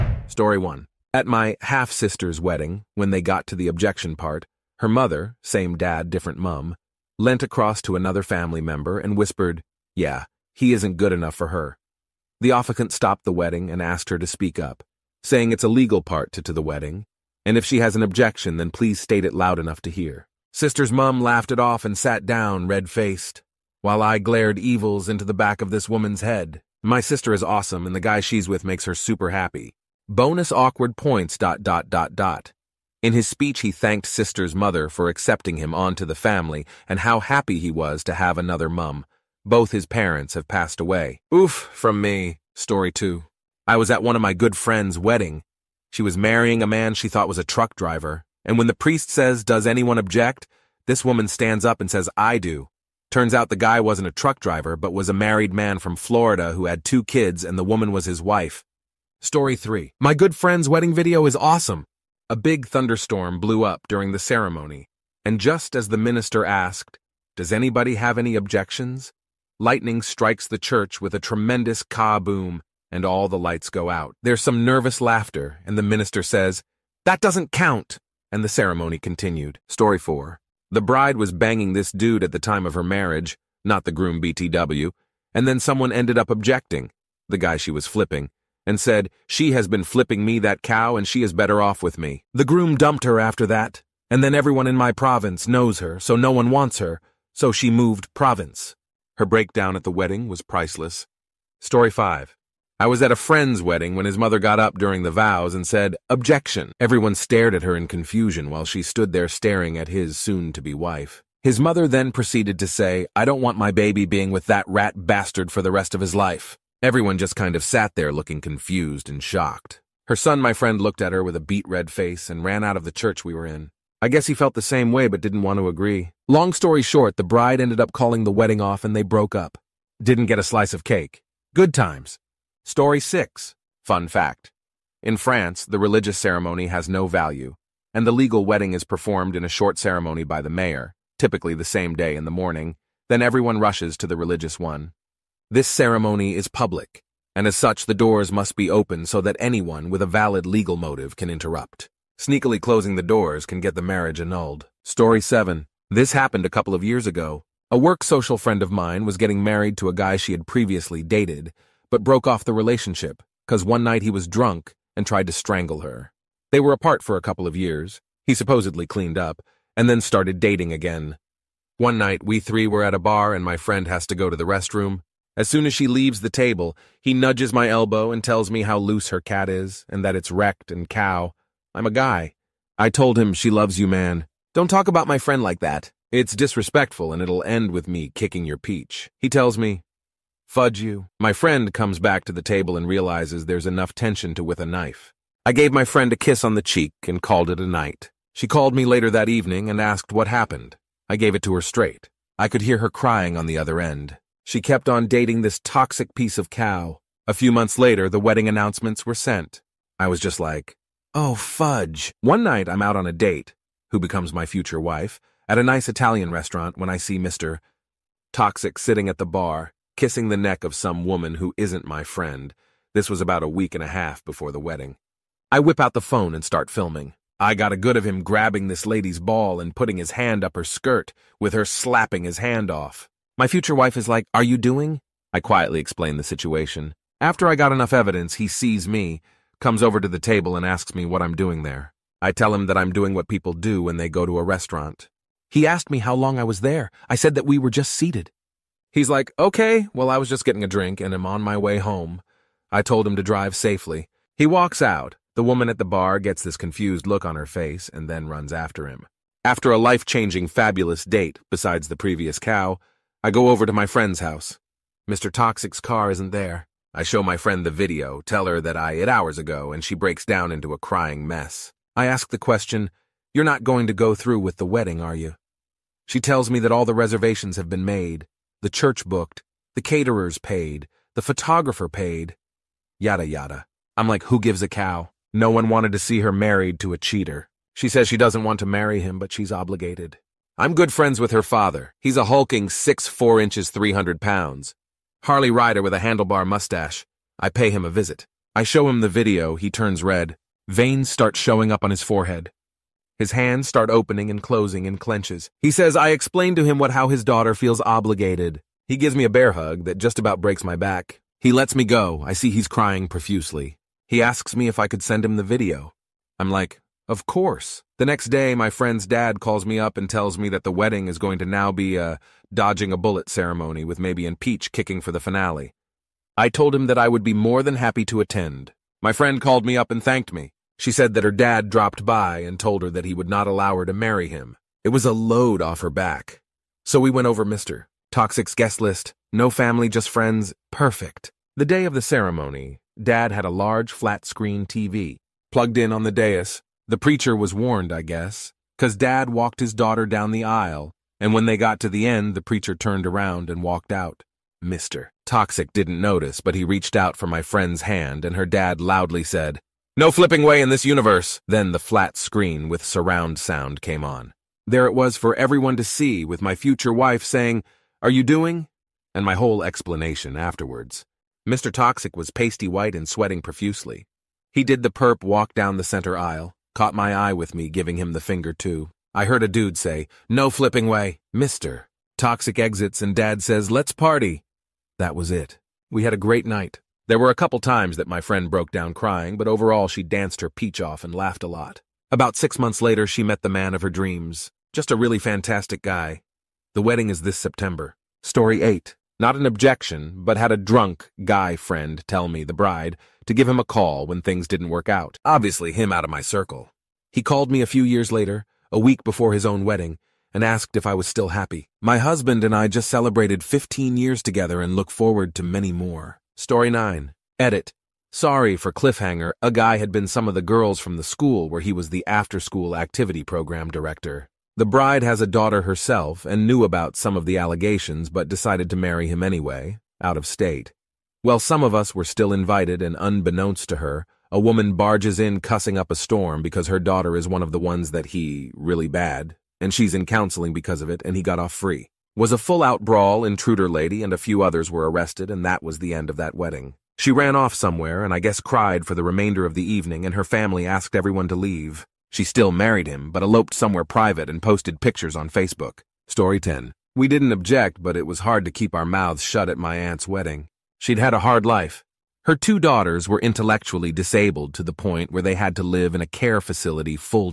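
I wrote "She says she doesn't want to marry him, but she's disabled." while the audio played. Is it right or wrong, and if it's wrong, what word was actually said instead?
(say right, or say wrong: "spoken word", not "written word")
wrong: "obligated", not "disabled".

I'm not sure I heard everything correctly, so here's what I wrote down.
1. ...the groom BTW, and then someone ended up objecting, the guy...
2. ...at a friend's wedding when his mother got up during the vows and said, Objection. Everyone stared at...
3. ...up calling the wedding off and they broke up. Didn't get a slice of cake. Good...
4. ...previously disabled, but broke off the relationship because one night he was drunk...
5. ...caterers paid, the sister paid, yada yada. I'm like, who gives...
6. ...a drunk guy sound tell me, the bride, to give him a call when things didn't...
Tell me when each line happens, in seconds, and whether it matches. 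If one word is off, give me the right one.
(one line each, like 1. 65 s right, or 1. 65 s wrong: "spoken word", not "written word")
1. 83 s right
2. 103 s right
3. 127 s right
4. 160 s wrong: "dated", not "disabled"
5. 279 s wrong: "photographer", not "sister"
6. 400 s wrong: "friend", not "sound".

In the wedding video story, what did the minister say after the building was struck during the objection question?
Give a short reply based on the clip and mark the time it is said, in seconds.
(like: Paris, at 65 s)
That doesn't count!, at 77 s.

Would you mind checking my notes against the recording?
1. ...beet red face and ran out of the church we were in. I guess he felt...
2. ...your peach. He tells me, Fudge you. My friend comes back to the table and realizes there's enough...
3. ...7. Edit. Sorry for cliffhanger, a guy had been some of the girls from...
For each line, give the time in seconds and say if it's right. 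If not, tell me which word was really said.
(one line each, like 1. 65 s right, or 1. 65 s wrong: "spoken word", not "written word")
1. 121 s right
2. 188 s right
3. 416 s wrong: "9", not "7".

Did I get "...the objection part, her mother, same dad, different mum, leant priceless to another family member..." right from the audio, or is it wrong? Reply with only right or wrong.
wrong.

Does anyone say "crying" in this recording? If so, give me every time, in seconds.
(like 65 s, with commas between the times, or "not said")
202 s, 270 s, 312 s, 388 s.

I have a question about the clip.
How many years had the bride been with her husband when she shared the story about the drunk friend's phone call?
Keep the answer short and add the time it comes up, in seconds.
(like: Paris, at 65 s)
15, at 413 s.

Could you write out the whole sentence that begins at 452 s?
She still married him but eloped somewhere private and posted pictures on Facebook.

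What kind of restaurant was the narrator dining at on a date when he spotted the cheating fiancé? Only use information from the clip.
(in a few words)
Italian.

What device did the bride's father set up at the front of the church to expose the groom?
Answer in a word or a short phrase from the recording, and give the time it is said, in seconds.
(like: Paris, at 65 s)
flat screen TV, at 343 s.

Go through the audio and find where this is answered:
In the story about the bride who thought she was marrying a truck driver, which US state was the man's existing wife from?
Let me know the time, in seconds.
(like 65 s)
55 s.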